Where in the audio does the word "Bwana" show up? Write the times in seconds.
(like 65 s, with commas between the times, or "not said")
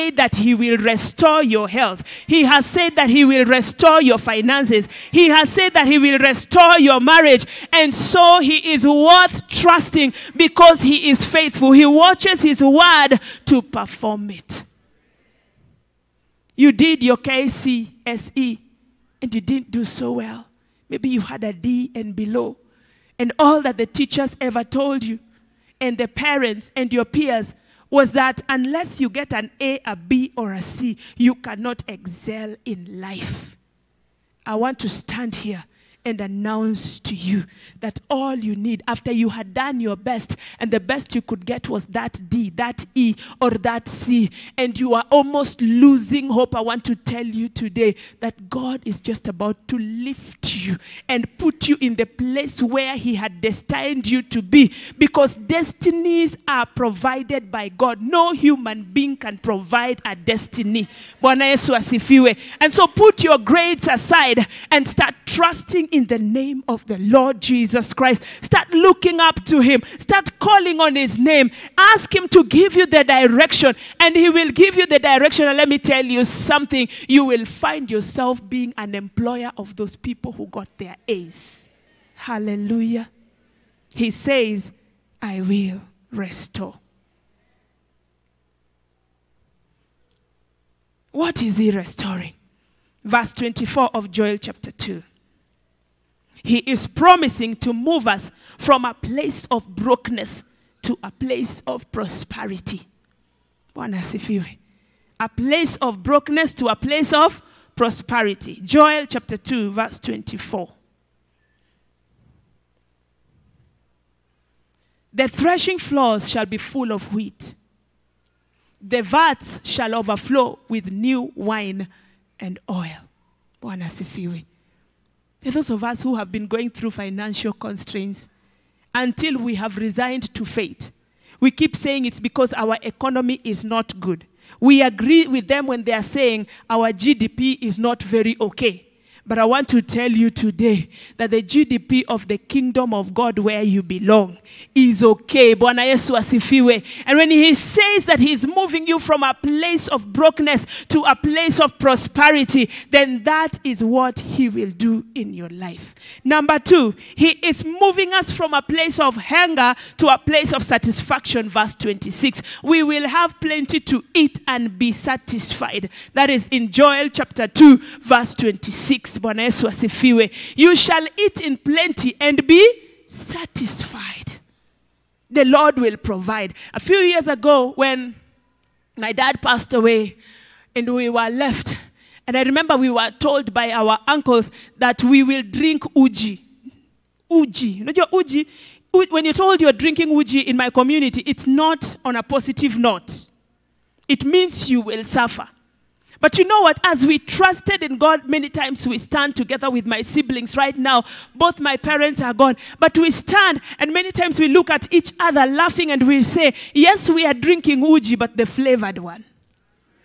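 61 s, 123 s, 145 s, 169 s.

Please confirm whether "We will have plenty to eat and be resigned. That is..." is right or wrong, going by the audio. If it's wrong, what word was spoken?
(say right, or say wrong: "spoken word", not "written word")
wrong: "satisfied", not "resigned".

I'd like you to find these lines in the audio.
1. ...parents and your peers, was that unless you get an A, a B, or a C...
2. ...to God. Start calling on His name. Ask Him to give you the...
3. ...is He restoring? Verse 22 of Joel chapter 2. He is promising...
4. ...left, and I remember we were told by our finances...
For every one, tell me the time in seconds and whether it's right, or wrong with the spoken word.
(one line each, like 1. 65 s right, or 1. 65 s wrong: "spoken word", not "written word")
1. 26 s right
2. 69 s wrong: "Him", not "God"
3. 91 s wrong: "24", not "22"
4. 181 s wrong: "uncles", not "finances".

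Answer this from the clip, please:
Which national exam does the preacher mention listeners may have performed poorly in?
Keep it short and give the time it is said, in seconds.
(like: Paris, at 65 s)
KCSE, at 17 s.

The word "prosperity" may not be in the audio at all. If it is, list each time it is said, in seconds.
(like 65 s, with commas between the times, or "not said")
101 s, 107 s, 151 s.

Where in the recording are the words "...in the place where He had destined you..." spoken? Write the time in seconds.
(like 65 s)
51 s.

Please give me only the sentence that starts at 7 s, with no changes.
And so he is worth trusting because he is faithful.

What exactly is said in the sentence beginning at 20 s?
Maybe you had a D and below.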